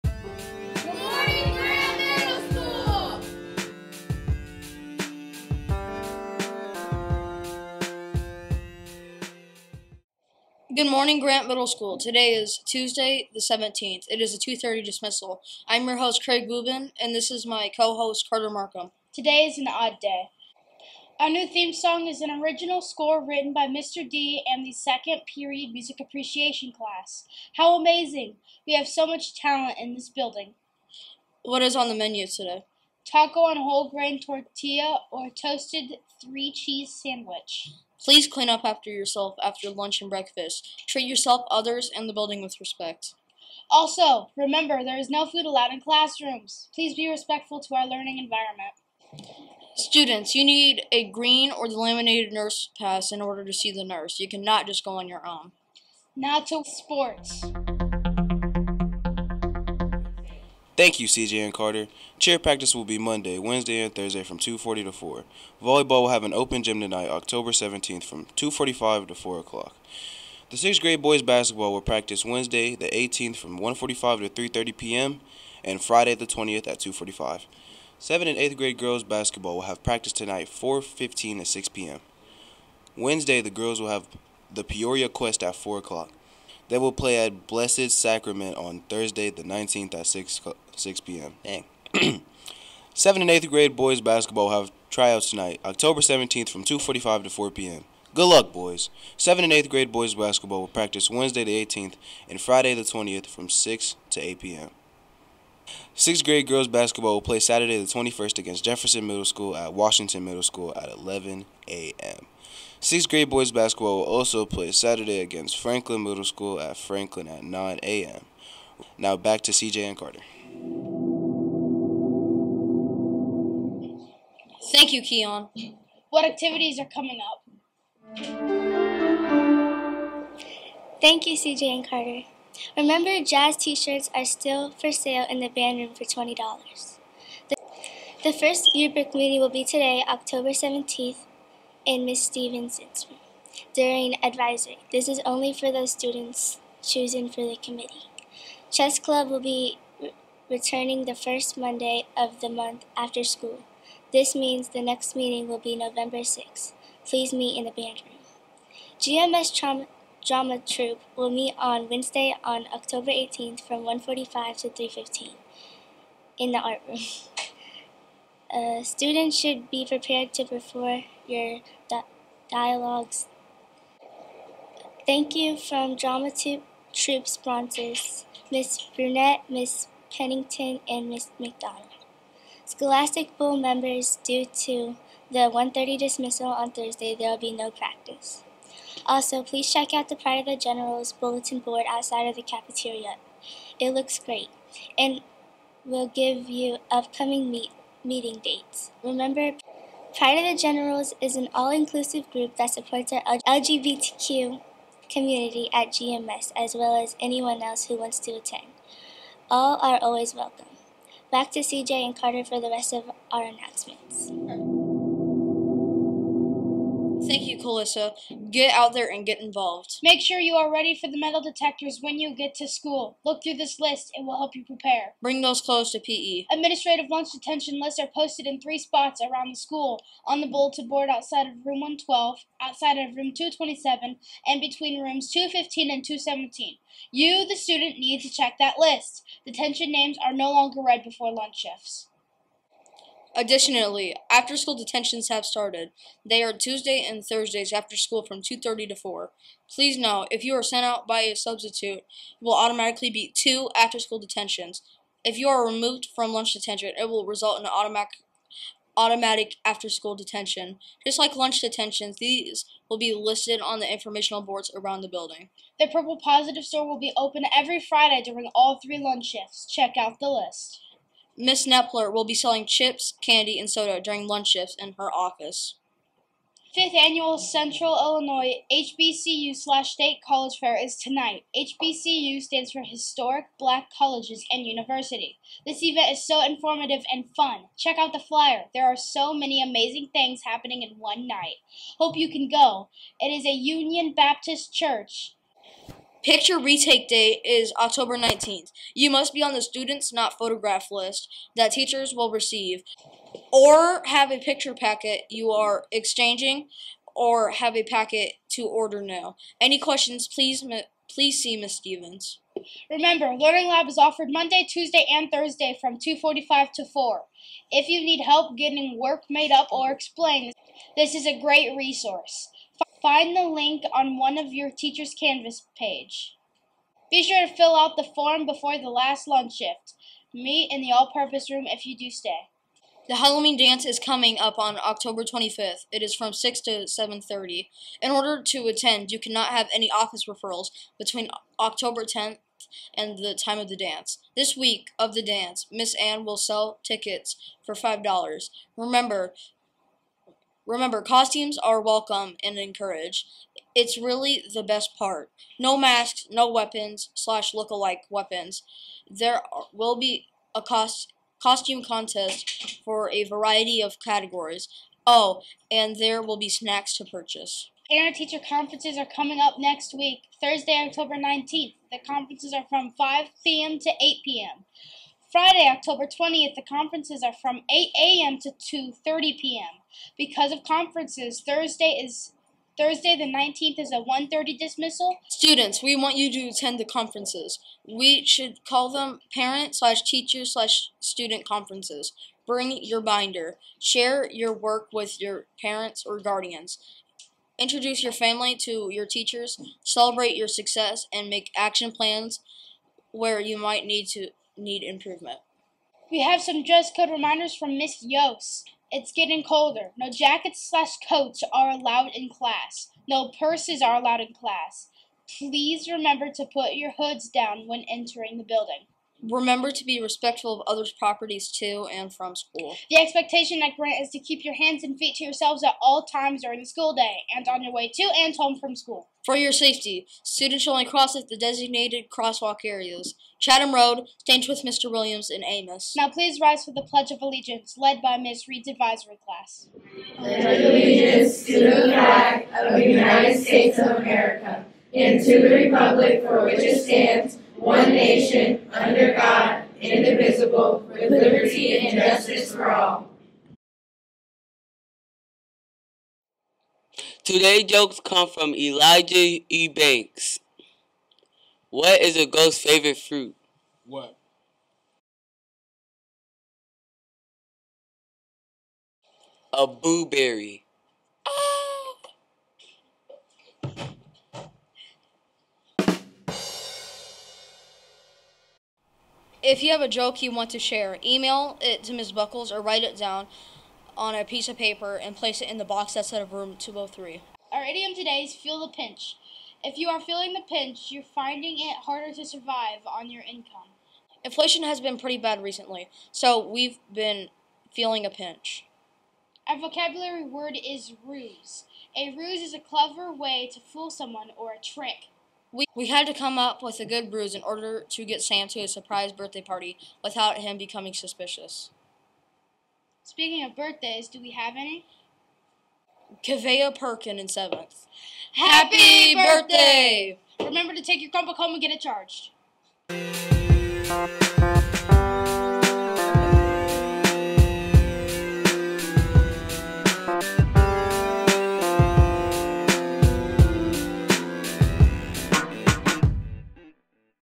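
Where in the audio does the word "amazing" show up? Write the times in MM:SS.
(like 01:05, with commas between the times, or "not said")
00:27, 04:49.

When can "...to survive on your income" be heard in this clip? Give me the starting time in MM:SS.
08:12.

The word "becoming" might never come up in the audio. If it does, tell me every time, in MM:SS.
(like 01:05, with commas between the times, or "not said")
08:30.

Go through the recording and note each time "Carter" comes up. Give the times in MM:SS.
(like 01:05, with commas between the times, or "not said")
00:18, 01:01, 01:59, 02:11, 03:32.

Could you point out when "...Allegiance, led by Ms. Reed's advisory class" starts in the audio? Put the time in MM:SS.
07:17.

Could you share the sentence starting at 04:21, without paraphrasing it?
Just like lunch detentions, these will be listed on the informational boards around the building.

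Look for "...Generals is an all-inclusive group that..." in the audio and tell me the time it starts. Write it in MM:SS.
03:20.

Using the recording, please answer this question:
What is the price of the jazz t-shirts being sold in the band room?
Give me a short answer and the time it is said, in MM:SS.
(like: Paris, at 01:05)
$20, at 02:16.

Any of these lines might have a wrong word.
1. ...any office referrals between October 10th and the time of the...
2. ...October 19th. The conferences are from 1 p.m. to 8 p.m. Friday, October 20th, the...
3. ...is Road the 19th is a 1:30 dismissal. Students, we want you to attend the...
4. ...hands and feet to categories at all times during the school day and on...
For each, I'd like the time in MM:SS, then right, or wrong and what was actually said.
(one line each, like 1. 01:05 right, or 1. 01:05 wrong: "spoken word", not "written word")
1. 05:39 right
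2. 06:10 wrong: "5", not "1"
3. 06:22 wrong: "Thursday", not "Road"
4. 07:04 wrong: "yourselves", not "categories".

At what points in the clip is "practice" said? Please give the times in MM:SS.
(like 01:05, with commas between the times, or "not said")
01:02, 01:11, 01:19, 01:40, 03:07.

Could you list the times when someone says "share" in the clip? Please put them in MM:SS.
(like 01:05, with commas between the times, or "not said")
06:33, 08:00.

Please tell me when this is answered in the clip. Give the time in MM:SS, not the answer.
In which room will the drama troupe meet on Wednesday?
02:46.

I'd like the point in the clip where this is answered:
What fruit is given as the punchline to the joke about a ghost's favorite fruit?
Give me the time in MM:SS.
07:49.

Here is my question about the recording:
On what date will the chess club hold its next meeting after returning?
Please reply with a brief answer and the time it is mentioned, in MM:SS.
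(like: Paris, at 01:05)
November 6th, at 02:35.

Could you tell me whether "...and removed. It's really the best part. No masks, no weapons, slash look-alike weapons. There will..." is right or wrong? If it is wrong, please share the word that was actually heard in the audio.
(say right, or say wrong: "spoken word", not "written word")
wrong: "encouraged", not "removed".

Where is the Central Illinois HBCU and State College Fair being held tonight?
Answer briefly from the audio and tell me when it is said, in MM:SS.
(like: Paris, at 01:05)
Union Baptist Church, at 04:53.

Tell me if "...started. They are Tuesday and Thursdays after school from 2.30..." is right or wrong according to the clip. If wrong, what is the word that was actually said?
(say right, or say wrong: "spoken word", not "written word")
right.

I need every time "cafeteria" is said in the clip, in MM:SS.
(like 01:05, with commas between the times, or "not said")
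03:12.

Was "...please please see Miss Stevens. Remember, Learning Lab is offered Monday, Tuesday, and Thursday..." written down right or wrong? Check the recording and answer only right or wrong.
right.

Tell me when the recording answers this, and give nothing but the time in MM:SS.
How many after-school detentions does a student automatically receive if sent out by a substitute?
04:13.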